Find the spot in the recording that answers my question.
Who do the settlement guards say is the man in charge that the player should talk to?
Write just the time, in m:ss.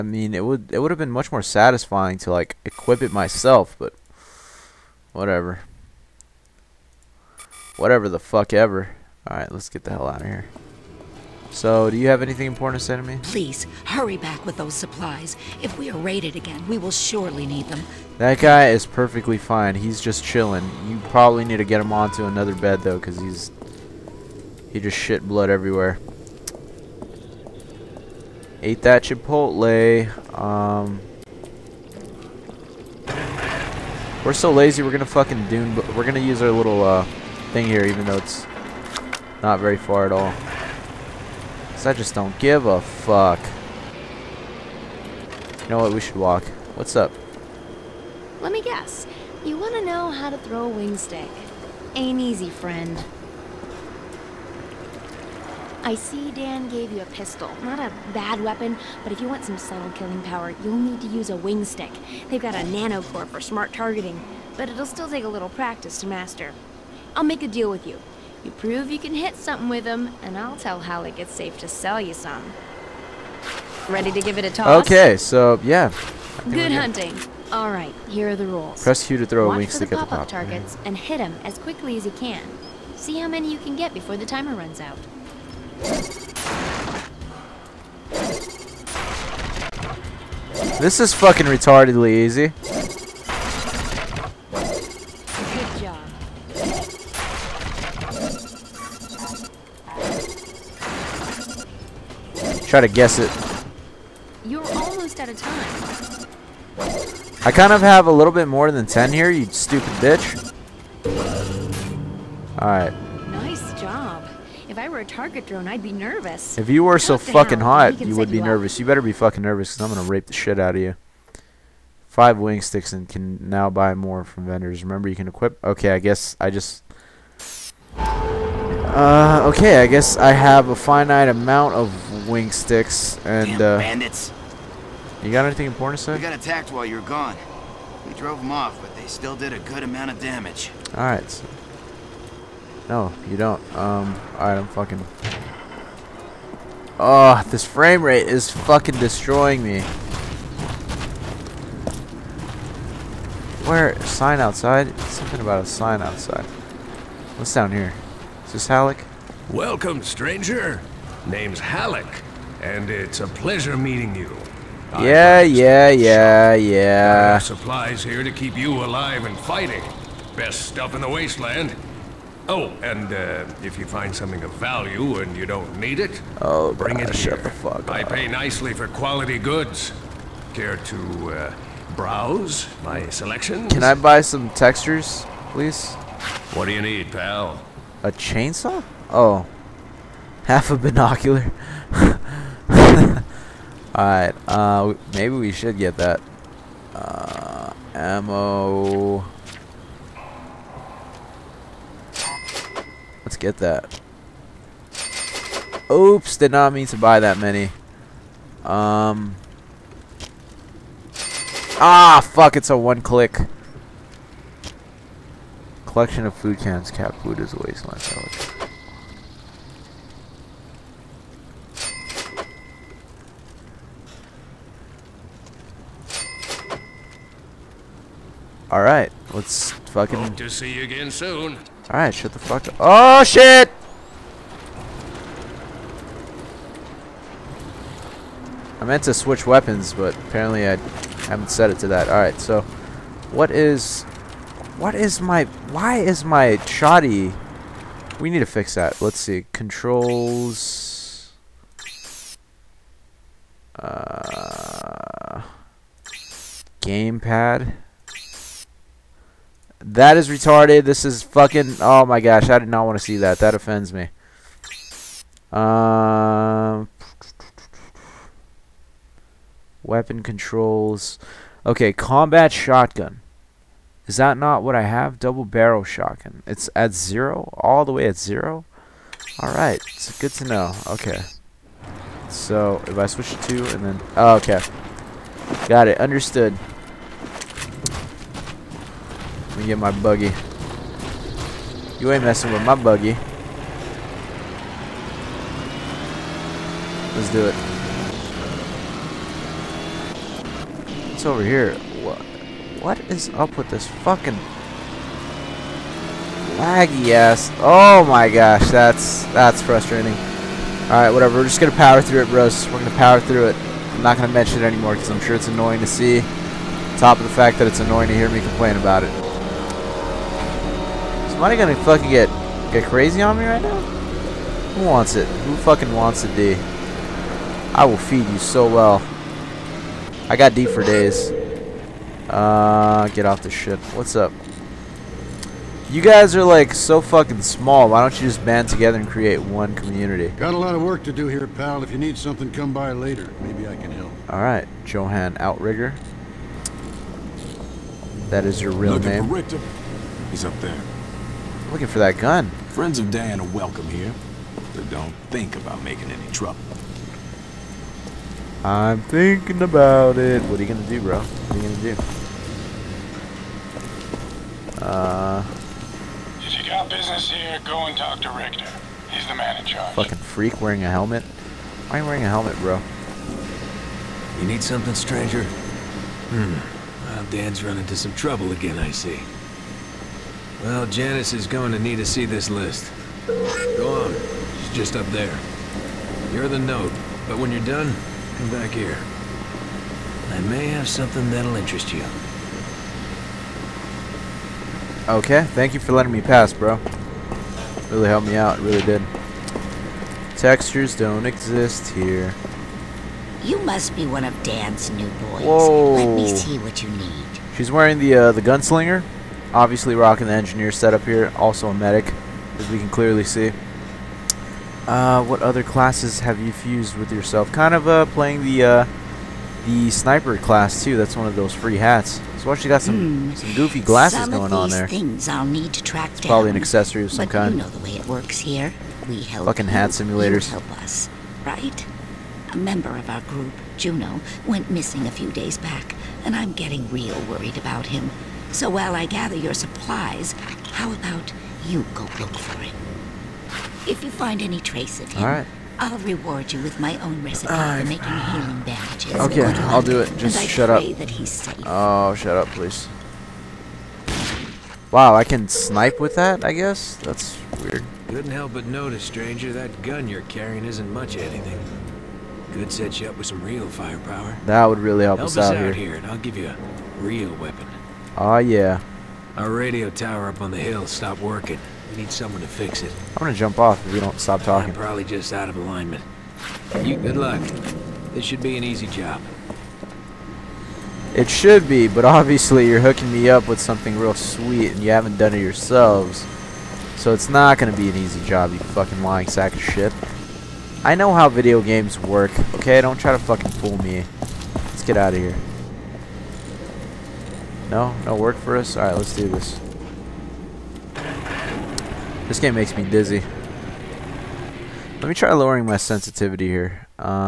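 6:08.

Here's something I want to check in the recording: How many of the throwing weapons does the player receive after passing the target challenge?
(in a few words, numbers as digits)
5.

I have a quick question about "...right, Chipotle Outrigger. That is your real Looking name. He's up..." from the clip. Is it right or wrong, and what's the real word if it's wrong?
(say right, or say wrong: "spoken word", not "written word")
wrong: "Johan", not "Chipotle".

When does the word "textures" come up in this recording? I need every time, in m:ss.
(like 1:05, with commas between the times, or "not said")
3:04, 6:40.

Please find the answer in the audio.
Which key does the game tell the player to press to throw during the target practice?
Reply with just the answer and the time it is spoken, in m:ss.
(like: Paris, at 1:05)
Q, at 1:19.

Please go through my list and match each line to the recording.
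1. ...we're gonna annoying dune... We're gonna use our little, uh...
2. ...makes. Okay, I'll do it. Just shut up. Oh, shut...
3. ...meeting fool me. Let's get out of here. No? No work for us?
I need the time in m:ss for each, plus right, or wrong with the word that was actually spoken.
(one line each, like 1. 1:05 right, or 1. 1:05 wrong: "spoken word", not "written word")
1. 0:34 wrong: "fucking", not "annoying"
2. 7:28 wrong: "bandages", not "makes"
3. 8:13 wrong: "fucking", not "meeting".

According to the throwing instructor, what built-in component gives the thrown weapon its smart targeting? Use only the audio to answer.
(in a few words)
Nanocore.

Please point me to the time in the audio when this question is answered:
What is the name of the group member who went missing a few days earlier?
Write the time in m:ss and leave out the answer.
7:13.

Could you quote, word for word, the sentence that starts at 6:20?
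Well, Janice is going to need to see this list.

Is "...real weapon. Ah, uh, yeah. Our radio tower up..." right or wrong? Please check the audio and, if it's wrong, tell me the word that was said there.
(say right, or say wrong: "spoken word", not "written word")
right.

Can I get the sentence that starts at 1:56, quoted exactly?
If you were so fucking hot, you would be you nervous.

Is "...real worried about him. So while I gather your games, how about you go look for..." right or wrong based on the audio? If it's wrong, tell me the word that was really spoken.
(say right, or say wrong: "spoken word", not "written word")
wrong: "supplies", not "games".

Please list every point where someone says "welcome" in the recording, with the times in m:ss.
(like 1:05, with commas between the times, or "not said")
2:39, 5:53.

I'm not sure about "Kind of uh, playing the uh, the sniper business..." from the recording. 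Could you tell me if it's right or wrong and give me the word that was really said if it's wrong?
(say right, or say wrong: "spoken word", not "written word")
wrong: "class", not "business".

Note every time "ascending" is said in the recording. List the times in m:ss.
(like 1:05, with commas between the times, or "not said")
not said.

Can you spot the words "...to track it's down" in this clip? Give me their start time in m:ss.
7:05.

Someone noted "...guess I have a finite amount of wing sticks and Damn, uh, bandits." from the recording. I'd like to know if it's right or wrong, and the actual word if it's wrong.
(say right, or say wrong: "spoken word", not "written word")
right.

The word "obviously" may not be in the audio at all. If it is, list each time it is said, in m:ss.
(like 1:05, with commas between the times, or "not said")
6:49, 8:02.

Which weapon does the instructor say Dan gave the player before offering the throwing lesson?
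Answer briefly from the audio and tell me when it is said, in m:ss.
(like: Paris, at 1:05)
Pistol, at 0:57.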